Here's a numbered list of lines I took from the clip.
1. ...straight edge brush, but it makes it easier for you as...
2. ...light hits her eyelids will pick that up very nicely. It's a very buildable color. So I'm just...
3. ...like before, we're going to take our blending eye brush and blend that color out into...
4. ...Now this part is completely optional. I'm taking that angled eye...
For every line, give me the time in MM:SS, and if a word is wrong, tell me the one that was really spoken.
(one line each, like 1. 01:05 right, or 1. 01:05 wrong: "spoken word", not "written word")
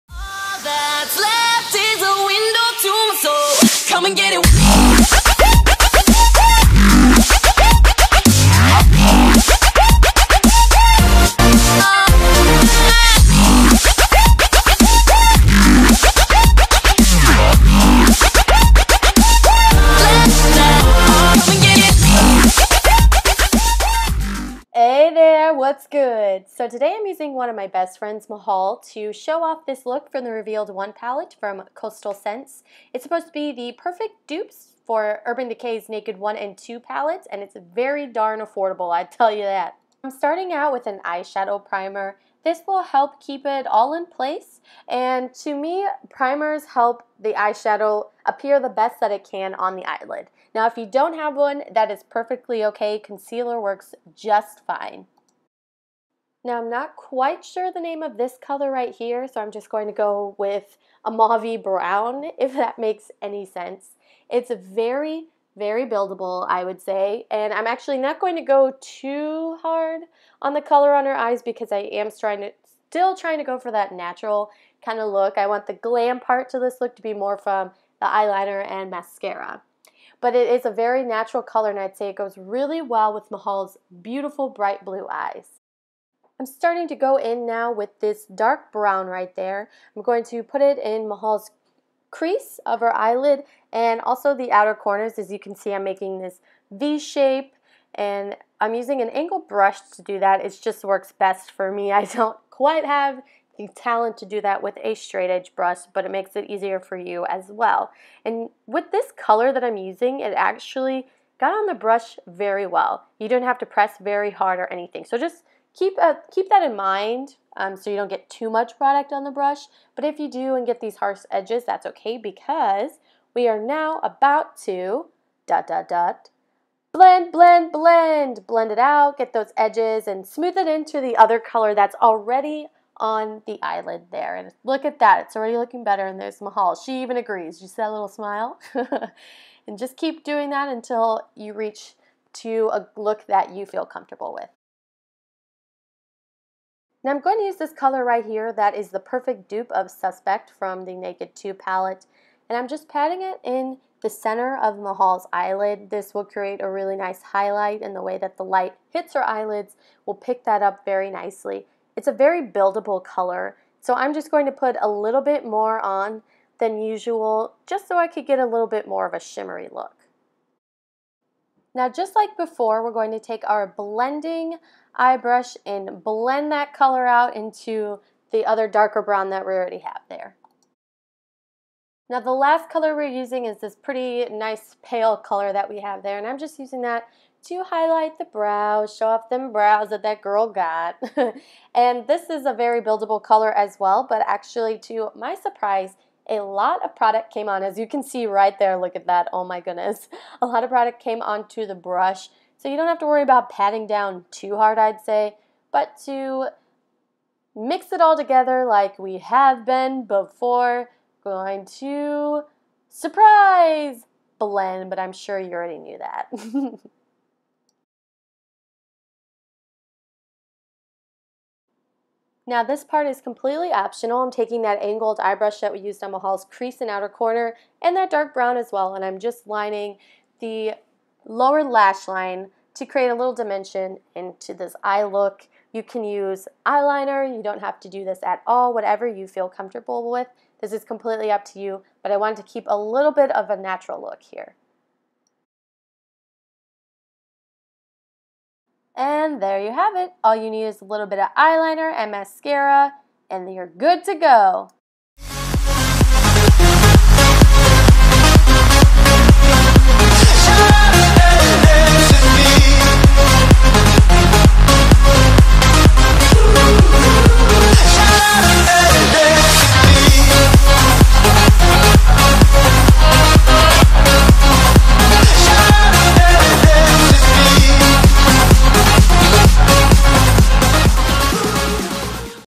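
1. 01:44 right
2. 02:38 right
3. 02:52 right
4. 03:42 right.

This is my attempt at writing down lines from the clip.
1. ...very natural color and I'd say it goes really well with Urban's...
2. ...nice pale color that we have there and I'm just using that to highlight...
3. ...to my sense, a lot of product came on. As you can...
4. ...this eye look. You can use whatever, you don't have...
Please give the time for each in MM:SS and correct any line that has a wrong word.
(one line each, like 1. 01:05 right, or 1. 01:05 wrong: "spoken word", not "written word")
1. 01:20 wrong: "Mahal", not "Urban"
2. 03:04 right
3. 03:14 wrong: "surprise", not "sense"
4. 03:54 wrong: "eyeliner", not "whatever".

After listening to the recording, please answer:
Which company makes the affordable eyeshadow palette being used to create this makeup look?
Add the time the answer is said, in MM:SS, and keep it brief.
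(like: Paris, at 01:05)
Coastal Scents, at 00:31.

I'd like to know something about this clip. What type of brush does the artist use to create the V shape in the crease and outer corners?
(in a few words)
angle brush.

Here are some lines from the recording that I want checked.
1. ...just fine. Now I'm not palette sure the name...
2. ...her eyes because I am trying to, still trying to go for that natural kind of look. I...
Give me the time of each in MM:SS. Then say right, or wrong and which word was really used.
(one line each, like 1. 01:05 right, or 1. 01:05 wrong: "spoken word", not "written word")
1. 00:54 wrong: "quite", not "palette"
2. 01:11 right.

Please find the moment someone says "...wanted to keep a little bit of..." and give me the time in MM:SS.
04:02.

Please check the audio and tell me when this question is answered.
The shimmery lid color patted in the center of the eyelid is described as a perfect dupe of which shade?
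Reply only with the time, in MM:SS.
02:29.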